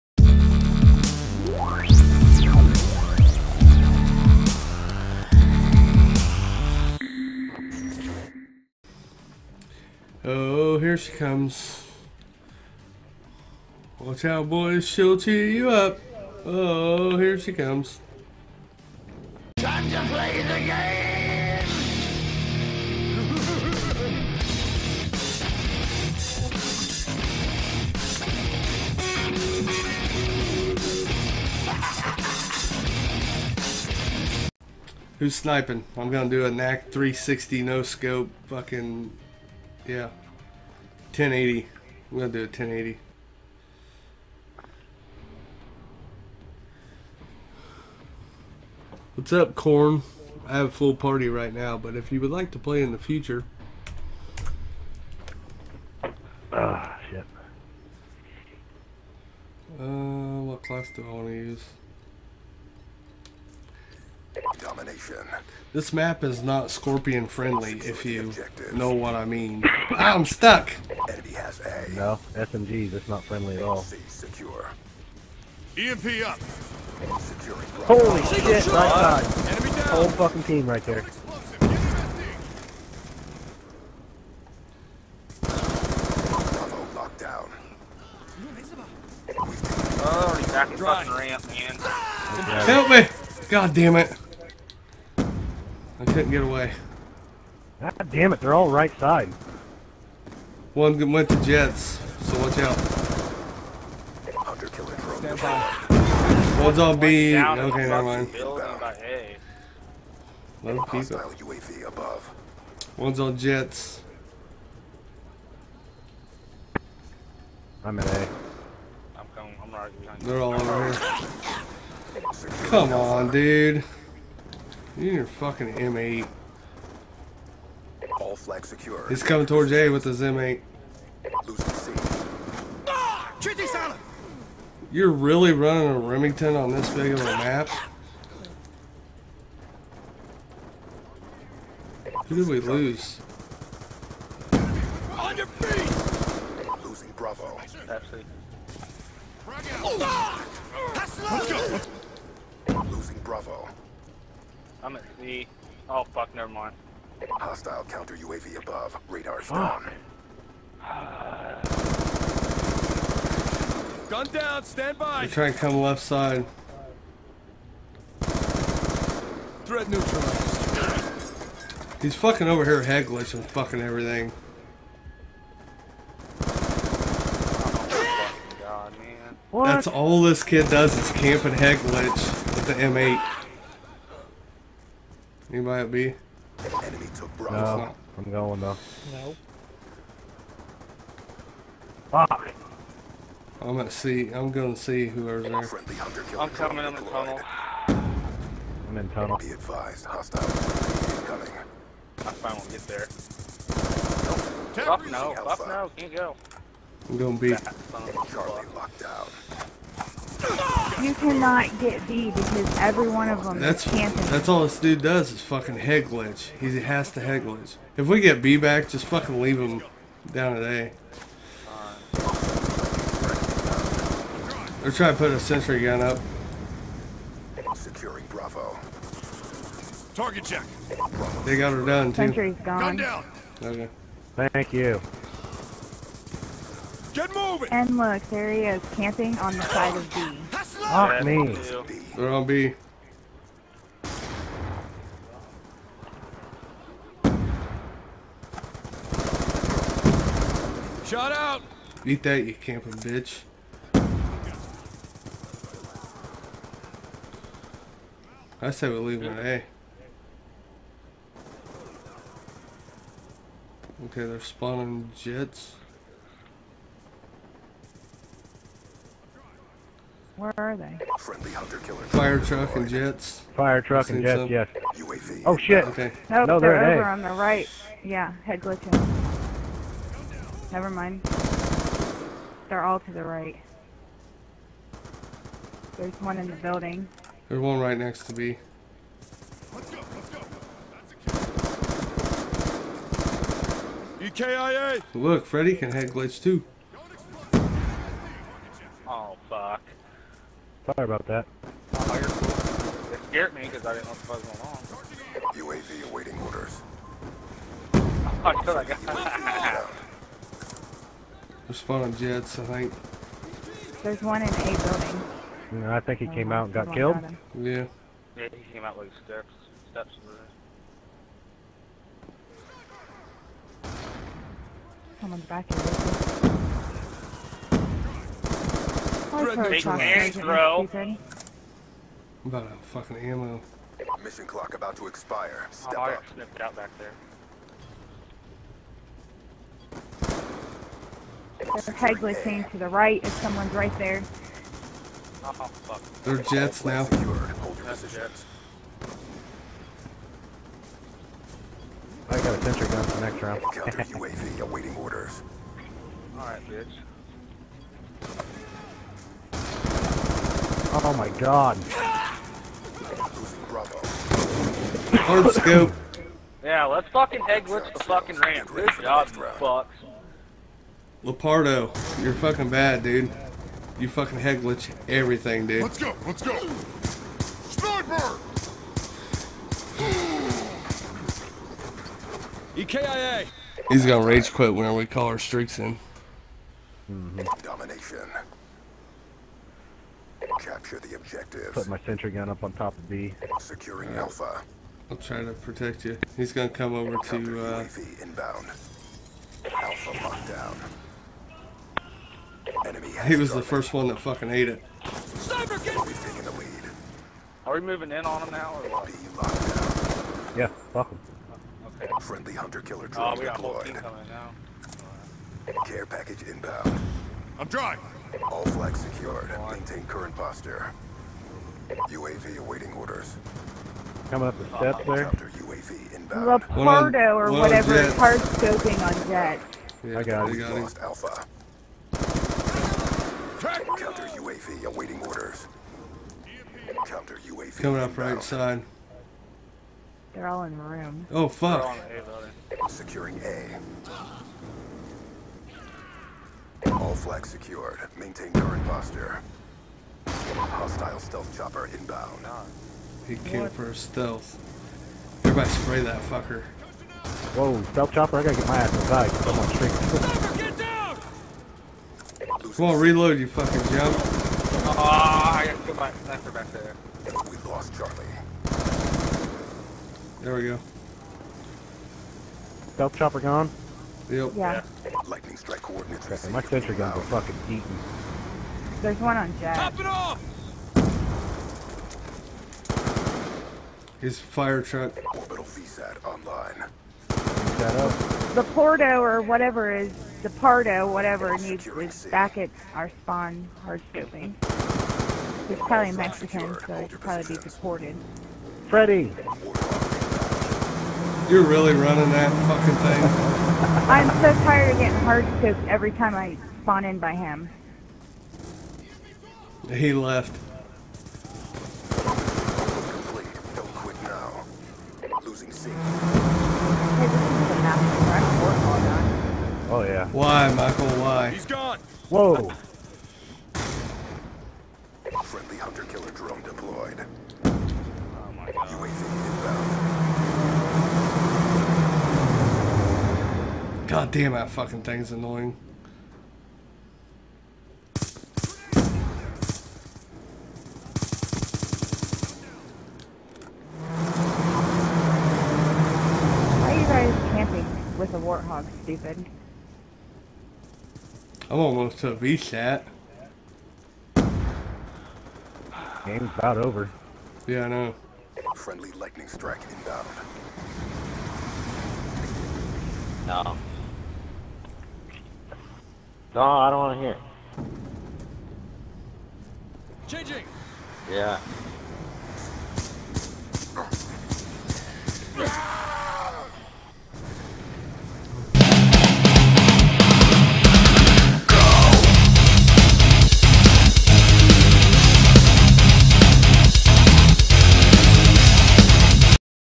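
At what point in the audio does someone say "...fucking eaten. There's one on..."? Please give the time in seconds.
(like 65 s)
477 s.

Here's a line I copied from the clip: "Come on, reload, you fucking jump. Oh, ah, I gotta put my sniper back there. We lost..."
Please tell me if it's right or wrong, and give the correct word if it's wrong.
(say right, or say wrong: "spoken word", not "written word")
right.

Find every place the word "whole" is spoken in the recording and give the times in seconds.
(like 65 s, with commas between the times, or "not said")
79 s, 413 s.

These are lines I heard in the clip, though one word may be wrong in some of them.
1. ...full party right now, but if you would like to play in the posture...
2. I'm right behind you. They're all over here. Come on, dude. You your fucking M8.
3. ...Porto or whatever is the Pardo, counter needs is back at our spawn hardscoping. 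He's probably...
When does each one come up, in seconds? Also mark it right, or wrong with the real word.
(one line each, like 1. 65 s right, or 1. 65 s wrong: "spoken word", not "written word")
1. 50 s wrong: "future", not "posture"
2. 119 s right
3. 488 s wrong: "whatever", not "counter".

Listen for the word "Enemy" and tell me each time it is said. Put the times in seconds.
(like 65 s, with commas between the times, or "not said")
71 s, 186 s, 402 s.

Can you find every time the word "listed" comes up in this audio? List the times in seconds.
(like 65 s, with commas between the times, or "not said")
not said.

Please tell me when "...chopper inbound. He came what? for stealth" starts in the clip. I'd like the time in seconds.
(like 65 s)
451 s.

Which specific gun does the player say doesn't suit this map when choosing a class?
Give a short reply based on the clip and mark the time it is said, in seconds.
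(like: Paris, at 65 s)
Skorpion, at 66 s.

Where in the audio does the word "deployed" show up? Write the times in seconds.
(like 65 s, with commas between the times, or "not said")
413 s, 526 s.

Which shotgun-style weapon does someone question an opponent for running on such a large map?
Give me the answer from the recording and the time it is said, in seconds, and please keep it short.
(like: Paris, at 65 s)
Remington, at 135 s.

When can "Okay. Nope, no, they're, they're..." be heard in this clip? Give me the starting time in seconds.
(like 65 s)
275 s.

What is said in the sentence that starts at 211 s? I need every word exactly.
You cannot get B because every one of them that's, That's all this dude does is fucking head glitch.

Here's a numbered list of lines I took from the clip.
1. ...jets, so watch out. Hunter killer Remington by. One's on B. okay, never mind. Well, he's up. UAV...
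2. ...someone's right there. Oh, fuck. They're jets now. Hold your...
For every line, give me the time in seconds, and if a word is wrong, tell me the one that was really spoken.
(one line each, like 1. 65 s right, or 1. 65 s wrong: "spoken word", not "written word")
1. 101 s wrong: "Stand", not "Remington"
2. 343 s right.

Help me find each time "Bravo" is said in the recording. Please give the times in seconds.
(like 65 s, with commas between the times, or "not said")
147 s, 153 s, 187 s, 228 s.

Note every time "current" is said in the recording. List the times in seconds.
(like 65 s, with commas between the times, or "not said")
420 s, 448 s.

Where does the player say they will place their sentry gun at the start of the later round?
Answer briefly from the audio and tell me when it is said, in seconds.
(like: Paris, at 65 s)
on top of B, at 392 s.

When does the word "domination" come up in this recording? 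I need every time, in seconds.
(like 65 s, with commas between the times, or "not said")
64 s, 387 s.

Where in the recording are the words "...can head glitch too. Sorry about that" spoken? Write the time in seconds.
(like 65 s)
295 s.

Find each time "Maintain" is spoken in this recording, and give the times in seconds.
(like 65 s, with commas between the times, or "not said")
419 s, 448 s.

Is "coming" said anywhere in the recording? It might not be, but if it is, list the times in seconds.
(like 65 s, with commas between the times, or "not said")
119 s, 129 s, 196 s, 201 s, 413 s, 424 s, 437 s.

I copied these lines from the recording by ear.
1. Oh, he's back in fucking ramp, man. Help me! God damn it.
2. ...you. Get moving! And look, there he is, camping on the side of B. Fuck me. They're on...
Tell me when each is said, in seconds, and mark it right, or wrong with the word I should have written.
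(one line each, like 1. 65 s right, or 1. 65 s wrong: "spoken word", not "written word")
1. 90 s right
2. 234 s right.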